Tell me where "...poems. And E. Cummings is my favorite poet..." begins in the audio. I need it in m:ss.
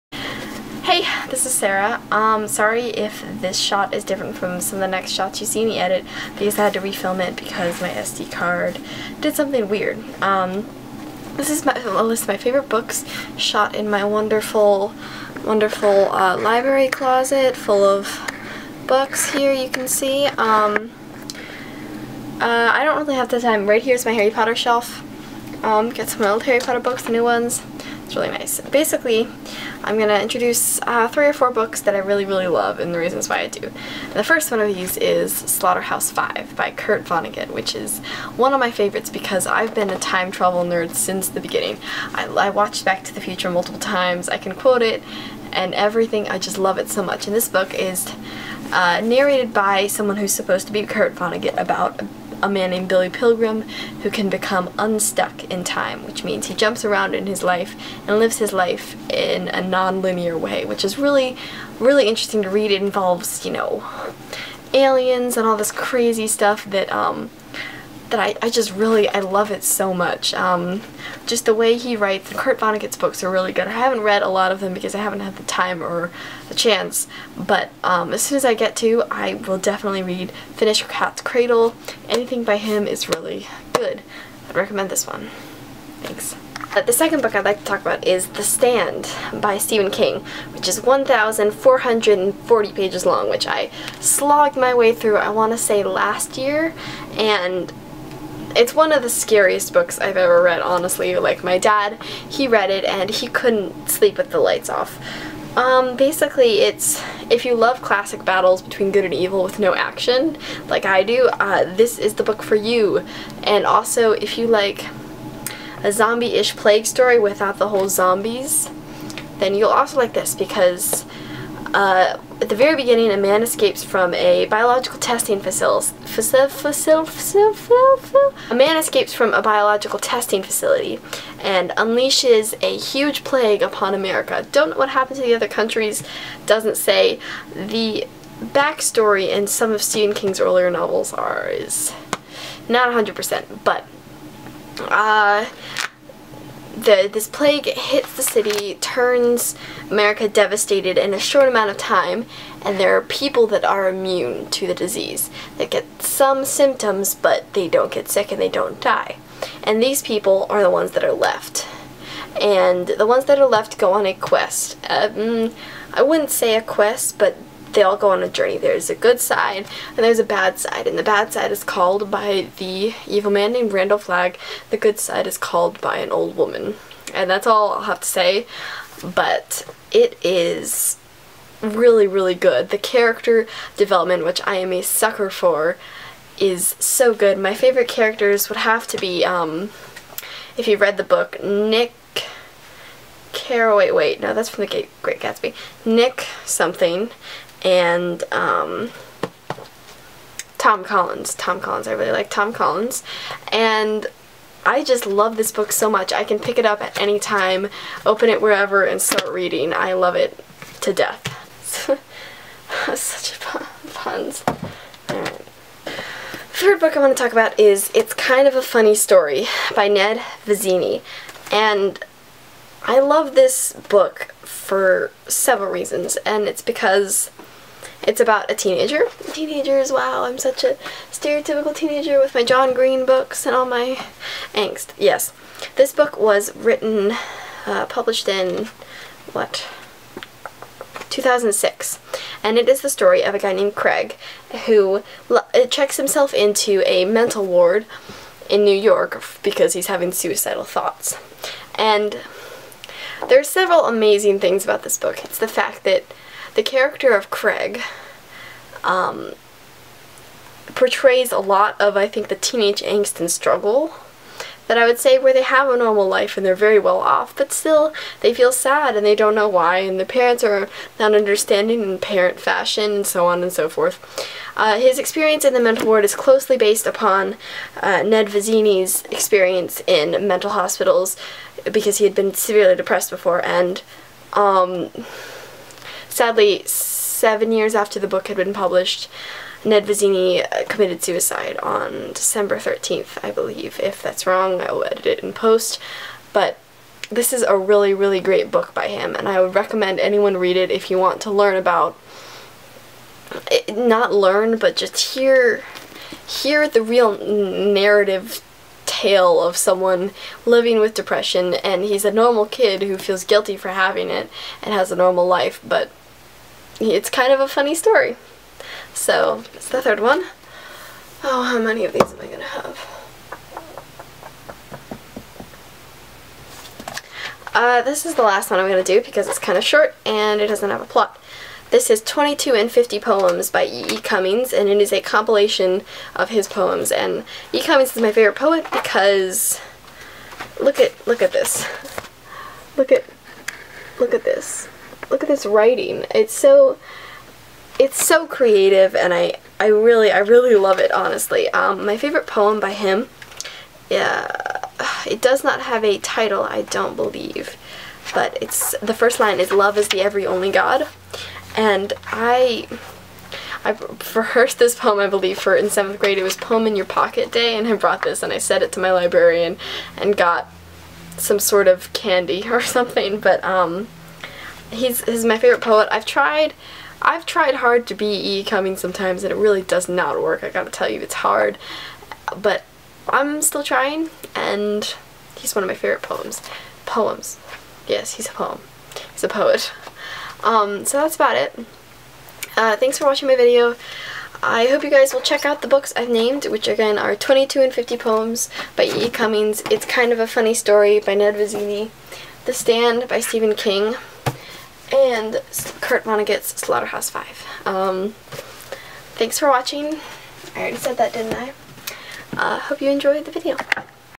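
5:36.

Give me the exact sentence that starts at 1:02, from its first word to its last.
It involves, you know, aliens and all this crazy stuff that um, that I, I just really, I love it so much.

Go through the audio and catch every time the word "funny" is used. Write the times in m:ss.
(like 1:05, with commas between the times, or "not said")
3:38, 5:17, 6:40.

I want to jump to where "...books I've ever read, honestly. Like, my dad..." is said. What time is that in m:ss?
1:39.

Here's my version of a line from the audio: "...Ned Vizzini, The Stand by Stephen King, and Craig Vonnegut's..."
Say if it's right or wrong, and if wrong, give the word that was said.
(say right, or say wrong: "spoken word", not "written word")
wrong: "Kurt", not "Craig".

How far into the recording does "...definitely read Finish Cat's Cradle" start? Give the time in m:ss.
1:19.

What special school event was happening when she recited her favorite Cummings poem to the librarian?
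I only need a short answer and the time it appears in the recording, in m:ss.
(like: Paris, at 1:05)
Poem in Your Pocket Day, at 6:06.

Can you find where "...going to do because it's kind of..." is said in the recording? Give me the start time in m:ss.
5:28.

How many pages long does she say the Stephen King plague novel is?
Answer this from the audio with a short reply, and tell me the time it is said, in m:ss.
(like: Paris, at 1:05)
1,440, at 1:30.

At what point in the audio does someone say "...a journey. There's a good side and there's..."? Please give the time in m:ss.
2:48.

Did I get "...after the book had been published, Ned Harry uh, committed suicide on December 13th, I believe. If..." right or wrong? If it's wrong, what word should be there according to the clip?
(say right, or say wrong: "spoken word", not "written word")
wrong: "Vizzini", not "Harry".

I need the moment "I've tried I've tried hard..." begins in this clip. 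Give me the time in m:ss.
6:15.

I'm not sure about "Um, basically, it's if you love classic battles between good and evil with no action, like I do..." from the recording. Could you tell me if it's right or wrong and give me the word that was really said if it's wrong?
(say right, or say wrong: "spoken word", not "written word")
right.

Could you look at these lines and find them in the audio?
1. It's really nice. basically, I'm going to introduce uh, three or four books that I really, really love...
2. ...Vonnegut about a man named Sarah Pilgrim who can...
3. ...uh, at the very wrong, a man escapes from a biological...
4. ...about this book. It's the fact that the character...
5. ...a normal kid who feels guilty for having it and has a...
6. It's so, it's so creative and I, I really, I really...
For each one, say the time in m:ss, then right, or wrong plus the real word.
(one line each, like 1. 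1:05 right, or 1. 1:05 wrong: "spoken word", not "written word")
1. 0:28 right
2. 0:51 wrong: "Billy", not "Sarah"
3. 2:01 wrong: "beginning", not "wrong"
4. 4:14 right
5. 5:12 right
6. 5:46 right.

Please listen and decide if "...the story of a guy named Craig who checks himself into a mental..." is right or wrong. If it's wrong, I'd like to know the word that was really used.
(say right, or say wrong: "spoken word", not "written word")
right.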